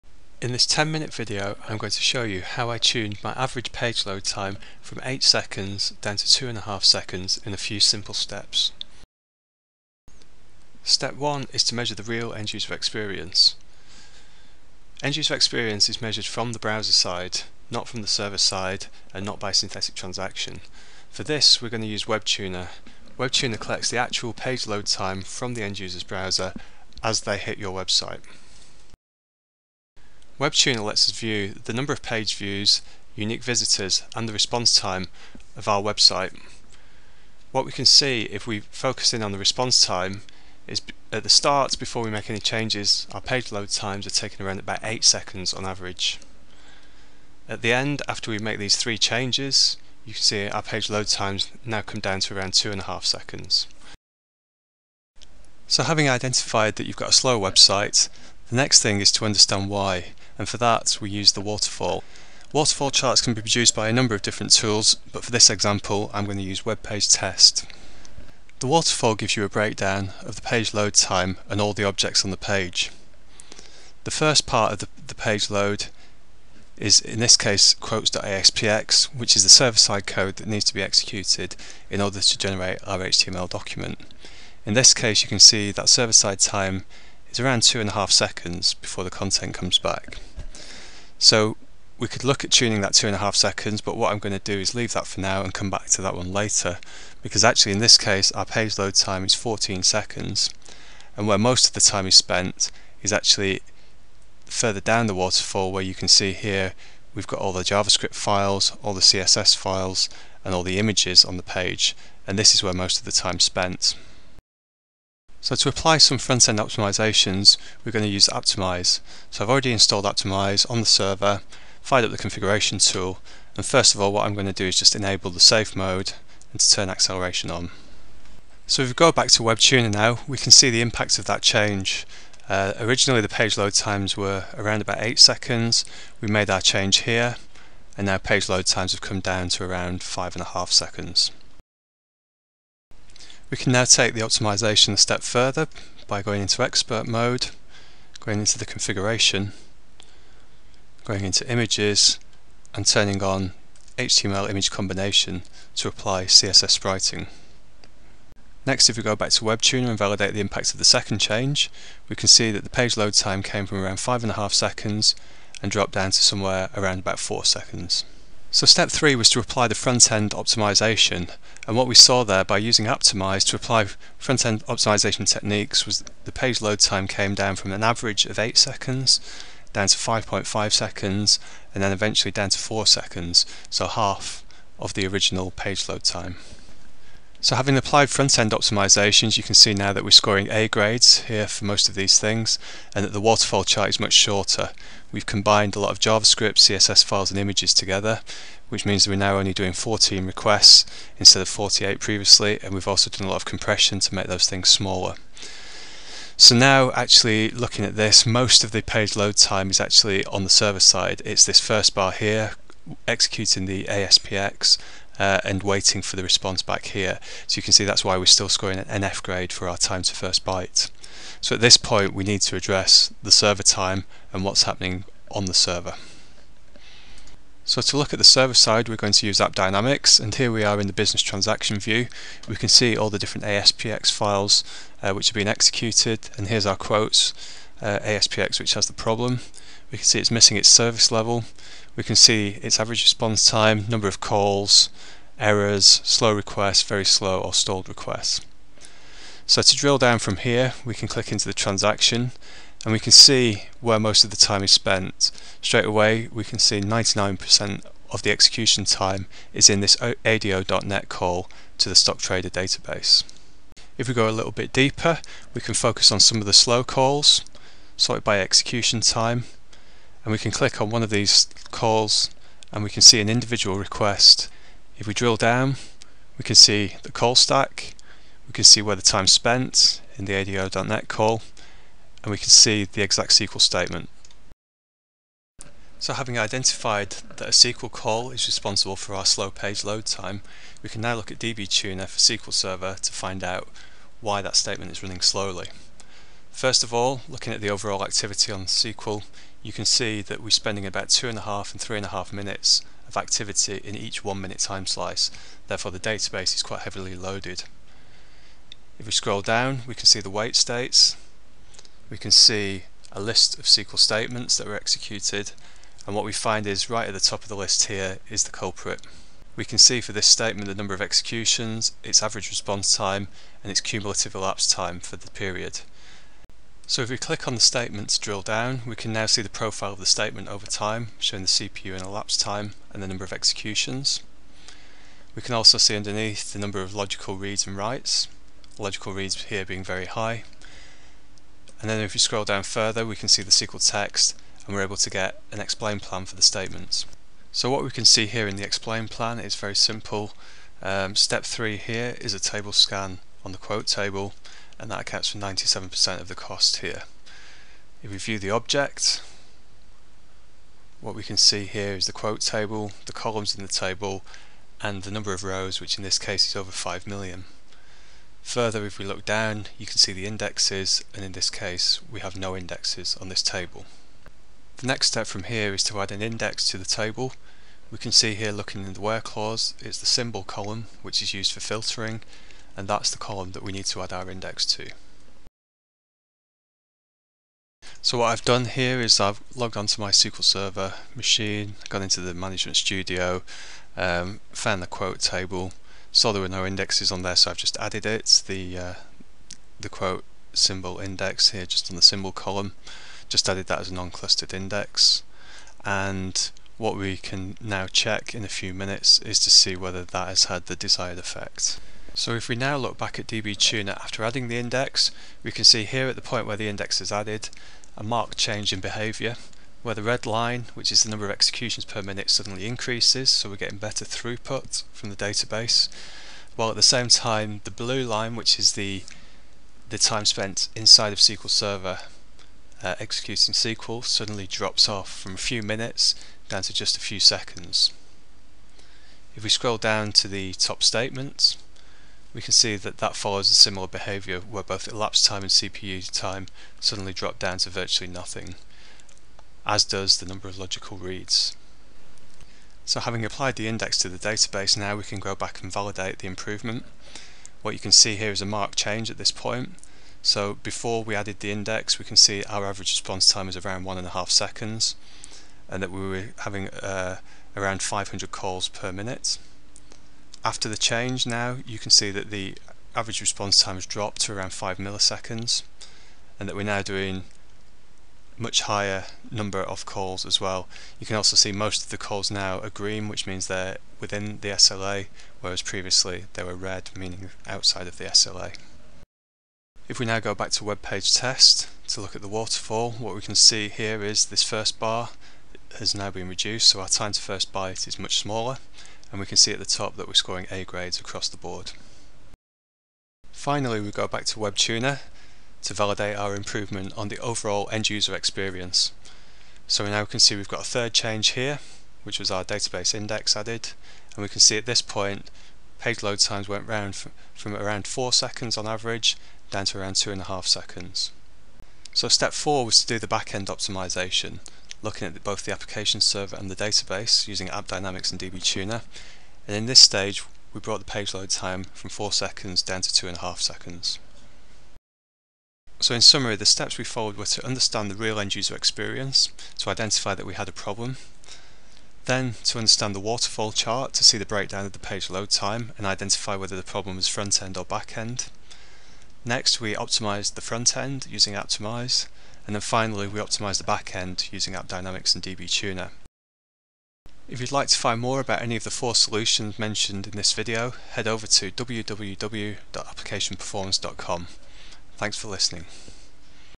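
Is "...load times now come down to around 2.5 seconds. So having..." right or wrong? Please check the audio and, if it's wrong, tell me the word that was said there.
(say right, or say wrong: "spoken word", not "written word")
right.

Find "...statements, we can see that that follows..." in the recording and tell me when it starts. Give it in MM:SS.
07:20.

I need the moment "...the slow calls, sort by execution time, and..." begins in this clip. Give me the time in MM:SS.
04:26.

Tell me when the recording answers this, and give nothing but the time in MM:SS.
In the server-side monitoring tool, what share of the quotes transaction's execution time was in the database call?
04:16.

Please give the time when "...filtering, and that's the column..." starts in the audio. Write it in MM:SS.
06:21.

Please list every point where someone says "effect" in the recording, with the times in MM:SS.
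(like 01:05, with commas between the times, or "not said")
06:51.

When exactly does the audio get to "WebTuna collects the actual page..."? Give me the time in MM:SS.
00:23.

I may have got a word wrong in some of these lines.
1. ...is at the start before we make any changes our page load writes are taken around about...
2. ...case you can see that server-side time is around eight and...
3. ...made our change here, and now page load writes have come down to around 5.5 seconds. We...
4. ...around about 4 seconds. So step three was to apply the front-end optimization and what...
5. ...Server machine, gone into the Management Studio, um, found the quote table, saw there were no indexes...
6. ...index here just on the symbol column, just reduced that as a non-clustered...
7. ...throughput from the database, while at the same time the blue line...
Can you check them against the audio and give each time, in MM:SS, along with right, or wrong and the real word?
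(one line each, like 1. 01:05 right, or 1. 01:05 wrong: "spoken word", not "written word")
1. 00:40 wrong: "times", not "writes"
2. 01:24 wrong: "two", not "eight"
3. 02:16 wrong: "times", not "writes"
4. 02:46 right
5. 06:30 right
6. 06:40 wrong: "added", not "reduced"
7. 07:04 right.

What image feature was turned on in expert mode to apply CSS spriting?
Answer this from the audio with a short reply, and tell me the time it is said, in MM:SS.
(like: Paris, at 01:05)
HTML image combination, at 02:33.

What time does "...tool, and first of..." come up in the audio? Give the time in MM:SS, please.
02:02.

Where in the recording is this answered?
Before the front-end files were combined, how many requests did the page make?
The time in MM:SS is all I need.
03:21.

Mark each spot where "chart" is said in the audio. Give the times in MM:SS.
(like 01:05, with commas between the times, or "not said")
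01:02, 03:13, 09:03.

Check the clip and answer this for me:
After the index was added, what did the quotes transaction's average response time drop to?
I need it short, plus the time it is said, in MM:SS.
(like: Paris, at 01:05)
5 milliseconds, at 07:54.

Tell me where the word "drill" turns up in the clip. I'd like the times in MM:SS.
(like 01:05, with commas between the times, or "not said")
04:09, 04:35, 05:28.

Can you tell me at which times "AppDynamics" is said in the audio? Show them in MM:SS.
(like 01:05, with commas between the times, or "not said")
03:49, 08:47, 09:14.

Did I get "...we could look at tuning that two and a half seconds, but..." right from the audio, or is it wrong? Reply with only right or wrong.
right.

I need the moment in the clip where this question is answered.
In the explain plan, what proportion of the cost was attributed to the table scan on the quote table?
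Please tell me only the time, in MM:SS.
05:55.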